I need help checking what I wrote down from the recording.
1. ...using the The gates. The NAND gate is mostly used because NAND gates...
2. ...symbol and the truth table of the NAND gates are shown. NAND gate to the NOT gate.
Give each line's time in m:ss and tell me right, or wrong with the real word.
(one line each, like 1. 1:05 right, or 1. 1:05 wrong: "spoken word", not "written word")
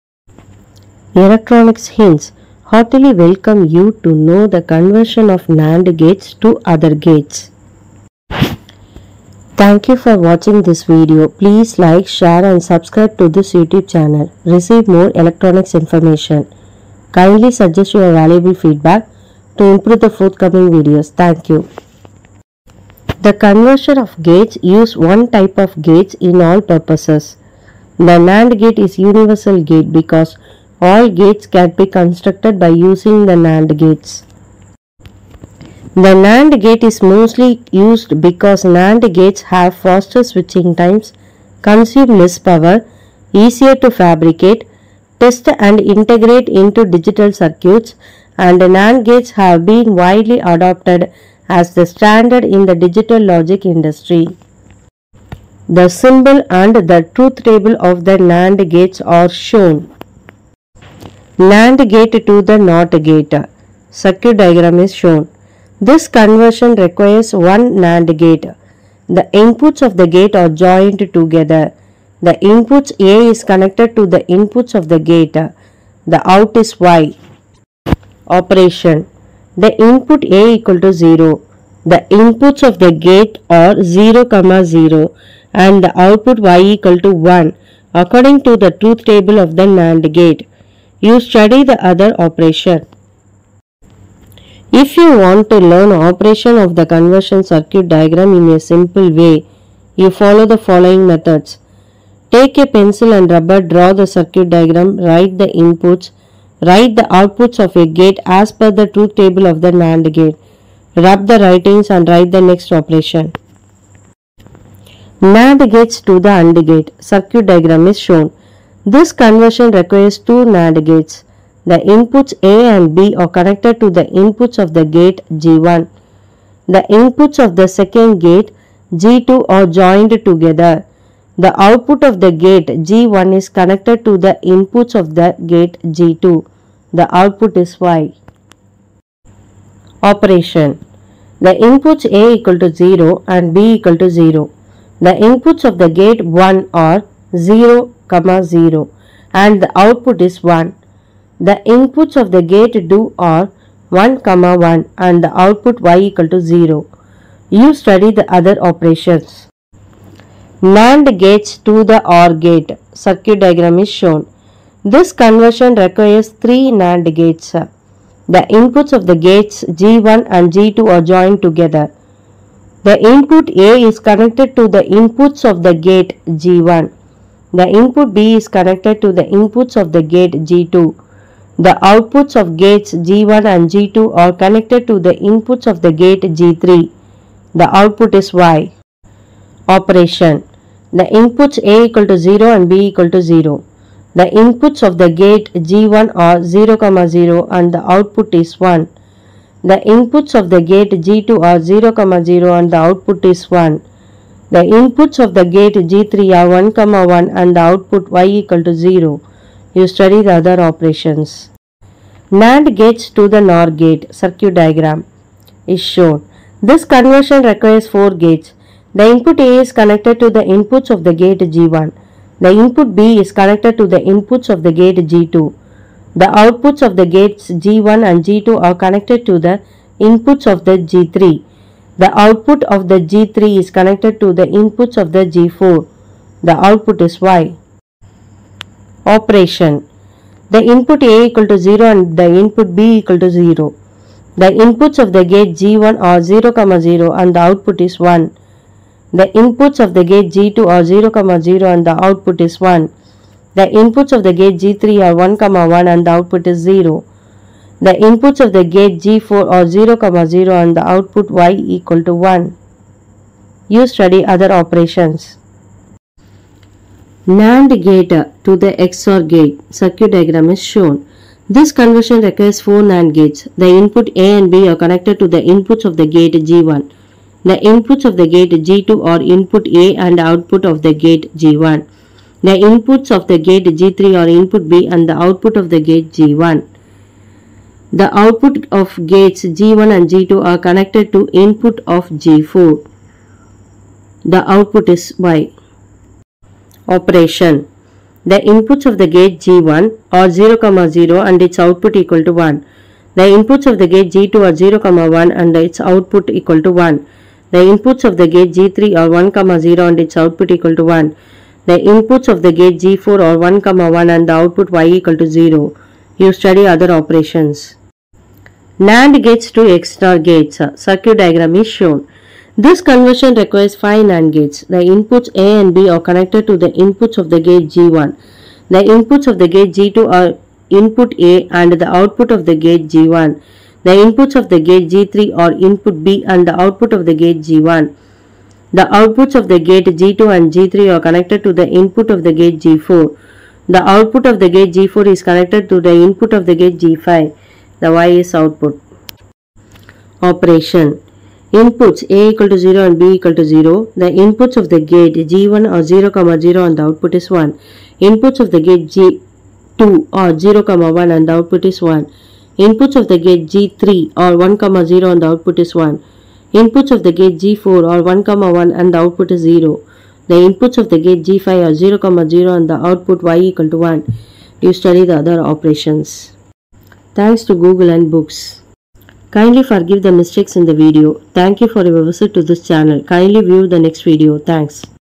1. 0:32 wrong: "NAND", not "The"
2. 0:55 right.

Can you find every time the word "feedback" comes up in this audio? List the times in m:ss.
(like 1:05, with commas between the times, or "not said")
0:18.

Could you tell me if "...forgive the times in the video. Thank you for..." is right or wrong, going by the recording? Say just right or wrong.
wrong.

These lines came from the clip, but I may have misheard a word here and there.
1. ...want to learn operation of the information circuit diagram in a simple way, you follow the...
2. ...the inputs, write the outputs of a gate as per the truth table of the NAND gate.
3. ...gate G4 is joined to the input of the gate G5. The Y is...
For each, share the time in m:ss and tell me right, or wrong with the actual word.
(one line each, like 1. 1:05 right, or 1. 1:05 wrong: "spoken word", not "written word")
1. 1:35 wrong: "conversion", not "information"
2. 1:45 right
3. 5:44 wrong: "connected", not "joined".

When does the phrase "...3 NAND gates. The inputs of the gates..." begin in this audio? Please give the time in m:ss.
2:46.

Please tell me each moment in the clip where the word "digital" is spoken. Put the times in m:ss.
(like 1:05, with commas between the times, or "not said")
0:46, 0:52.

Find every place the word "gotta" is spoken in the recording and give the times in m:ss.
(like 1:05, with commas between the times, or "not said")
not said.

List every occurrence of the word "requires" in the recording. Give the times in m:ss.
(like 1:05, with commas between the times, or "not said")
1:06, 1:59, 2:45, 3:37, 4:32, 5:23.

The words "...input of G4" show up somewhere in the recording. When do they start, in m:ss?
4:51.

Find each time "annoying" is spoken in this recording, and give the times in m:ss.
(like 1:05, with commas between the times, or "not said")
not said.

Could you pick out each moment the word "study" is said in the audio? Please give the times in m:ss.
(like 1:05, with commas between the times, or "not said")
1:31, 2:37, 3:29, 4:23, 5:16, 6:14.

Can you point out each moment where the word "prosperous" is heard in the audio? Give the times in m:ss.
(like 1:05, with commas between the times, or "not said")
not said.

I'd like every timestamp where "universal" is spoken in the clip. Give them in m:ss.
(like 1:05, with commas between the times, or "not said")
0:28.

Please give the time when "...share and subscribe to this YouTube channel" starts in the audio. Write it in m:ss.
0:12.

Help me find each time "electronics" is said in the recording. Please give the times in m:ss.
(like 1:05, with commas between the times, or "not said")
0:01, 0:15.